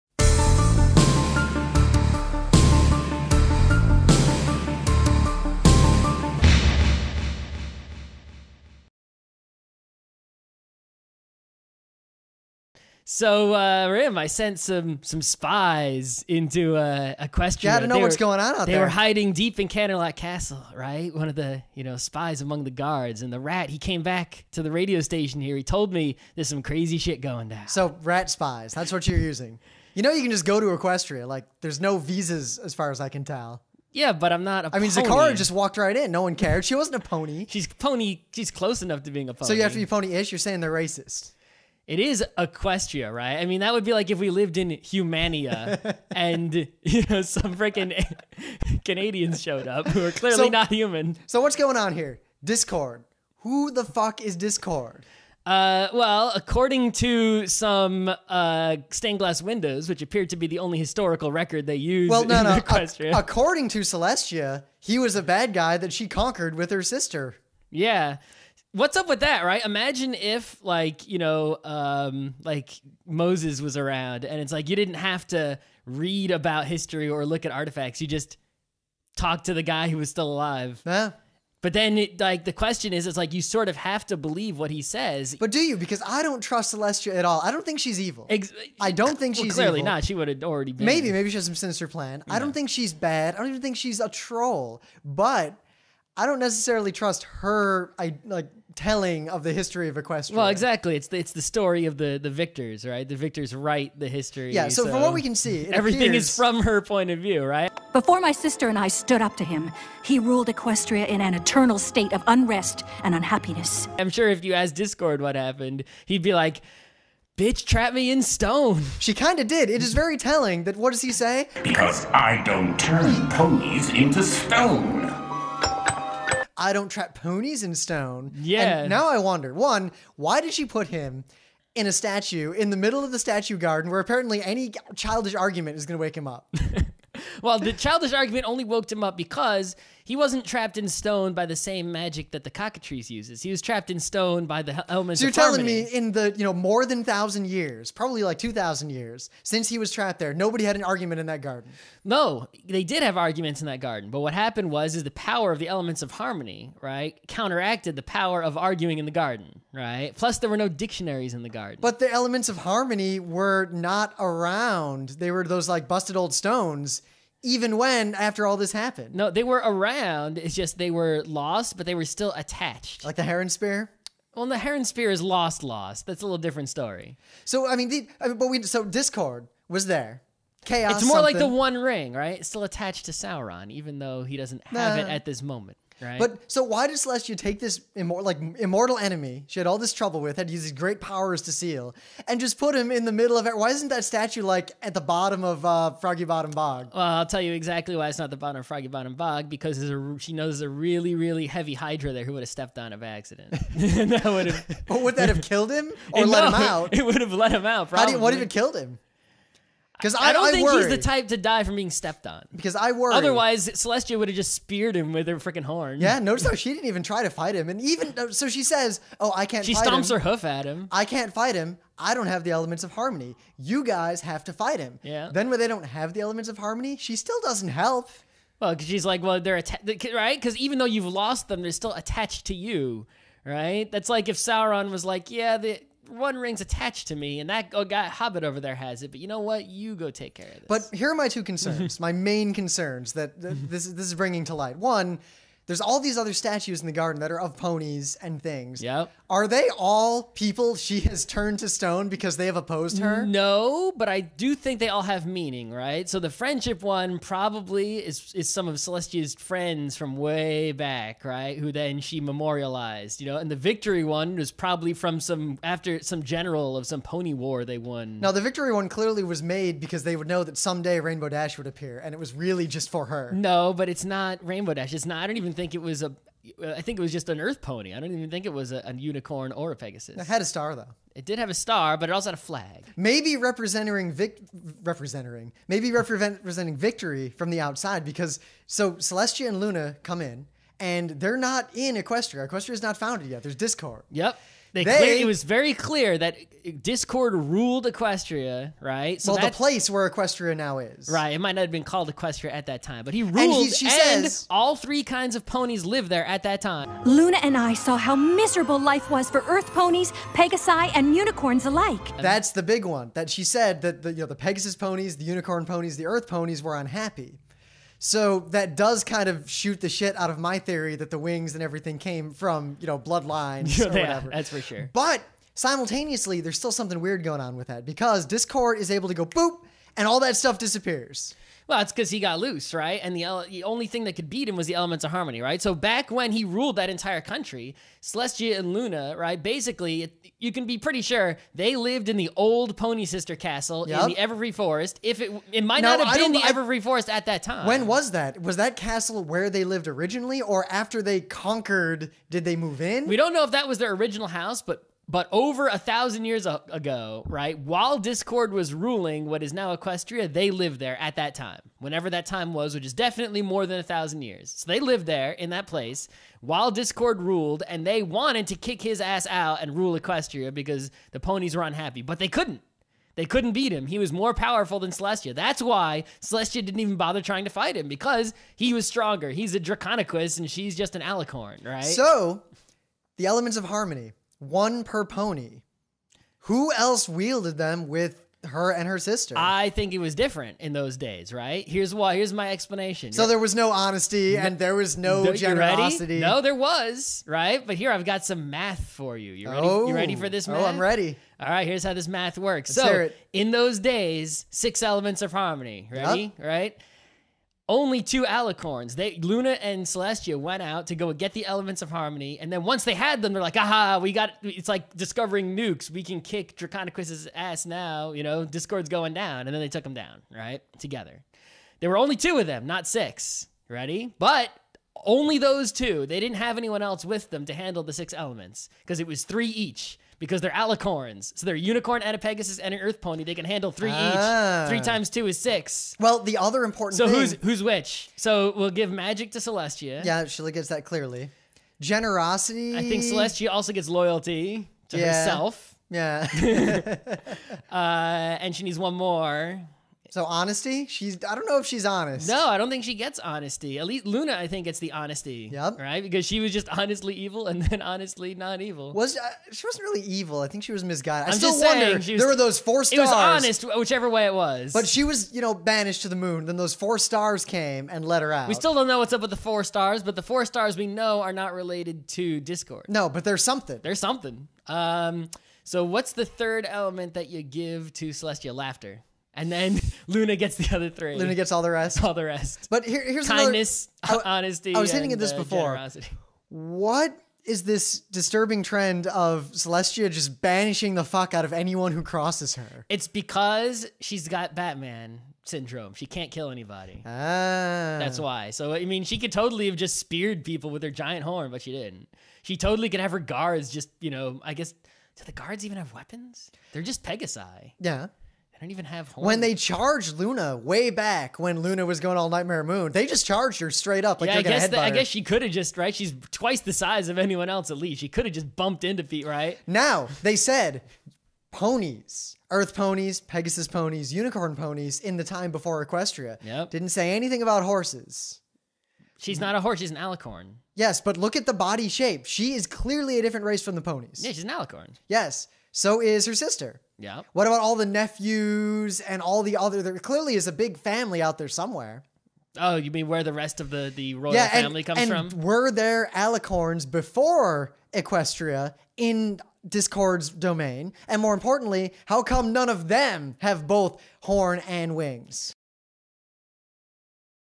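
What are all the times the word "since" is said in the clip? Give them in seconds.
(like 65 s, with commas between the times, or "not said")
149 s.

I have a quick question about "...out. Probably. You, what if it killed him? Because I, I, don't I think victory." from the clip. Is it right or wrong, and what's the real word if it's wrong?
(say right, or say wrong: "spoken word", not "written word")
wrong: "worry", not "victory".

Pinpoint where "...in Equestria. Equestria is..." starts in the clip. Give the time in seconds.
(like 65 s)
291 s.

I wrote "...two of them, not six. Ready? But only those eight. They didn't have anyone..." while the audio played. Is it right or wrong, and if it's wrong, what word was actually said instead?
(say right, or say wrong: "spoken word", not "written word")
wrong: "two", not "eight".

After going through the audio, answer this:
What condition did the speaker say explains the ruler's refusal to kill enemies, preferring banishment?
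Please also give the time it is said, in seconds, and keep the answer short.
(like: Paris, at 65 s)
Batman syndrome, at 494 s.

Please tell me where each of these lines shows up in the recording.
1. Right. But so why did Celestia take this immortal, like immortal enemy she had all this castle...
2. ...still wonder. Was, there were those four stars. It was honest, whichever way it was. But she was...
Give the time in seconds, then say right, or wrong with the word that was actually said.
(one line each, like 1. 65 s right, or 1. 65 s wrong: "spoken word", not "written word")
1. 186 s wrong: "trouble", not "castle"
2. 461 s right.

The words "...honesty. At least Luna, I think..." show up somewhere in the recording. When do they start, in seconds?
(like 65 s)
453 s.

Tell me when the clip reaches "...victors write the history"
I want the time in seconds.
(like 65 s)
103 s.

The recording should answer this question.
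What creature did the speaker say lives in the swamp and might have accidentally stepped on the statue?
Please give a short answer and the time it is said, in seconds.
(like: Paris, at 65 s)
Hydra, at 201 s.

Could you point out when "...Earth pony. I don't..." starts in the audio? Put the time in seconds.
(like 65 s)
277 s.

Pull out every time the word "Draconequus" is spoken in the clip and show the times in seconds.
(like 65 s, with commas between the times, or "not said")
379 s, 416 s.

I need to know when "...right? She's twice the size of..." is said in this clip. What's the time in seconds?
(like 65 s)
515 s.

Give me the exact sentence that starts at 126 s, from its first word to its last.
I don't trap ponies in stone.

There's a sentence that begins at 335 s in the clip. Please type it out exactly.
So back when he ruled that entire country, Celestia and Luna, right?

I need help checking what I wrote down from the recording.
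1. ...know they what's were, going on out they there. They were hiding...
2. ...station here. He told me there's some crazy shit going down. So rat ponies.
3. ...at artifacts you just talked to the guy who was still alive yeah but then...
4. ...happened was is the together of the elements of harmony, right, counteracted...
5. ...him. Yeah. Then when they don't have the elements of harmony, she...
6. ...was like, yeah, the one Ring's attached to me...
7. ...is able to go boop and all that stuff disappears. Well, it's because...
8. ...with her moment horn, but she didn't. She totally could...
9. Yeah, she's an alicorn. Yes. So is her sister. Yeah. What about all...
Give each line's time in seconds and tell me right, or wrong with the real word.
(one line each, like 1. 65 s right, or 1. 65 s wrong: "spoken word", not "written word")
1. 17 s right
2. 25 s wrong: "spies", not "ponies"
3. 77 s right
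4. 154 s wrong: "power", not "together"
5. 224 s right
6. 234 s right
7. 328 s right
8. 500 s wrong: "giant", not "moment"
9. 534 s right.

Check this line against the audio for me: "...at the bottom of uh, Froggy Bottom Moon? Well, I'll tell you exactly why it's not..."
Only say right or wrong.
wrong.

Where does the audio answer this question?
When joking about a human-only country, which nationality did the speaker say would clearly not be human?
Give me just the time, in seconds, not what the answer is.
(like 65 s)
48 s.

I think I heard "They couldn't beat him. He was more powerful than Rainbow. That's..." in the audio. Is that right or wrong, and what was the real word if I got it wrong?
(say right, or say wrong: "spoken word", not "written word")
wrong: "Celestia", not "Rainbow".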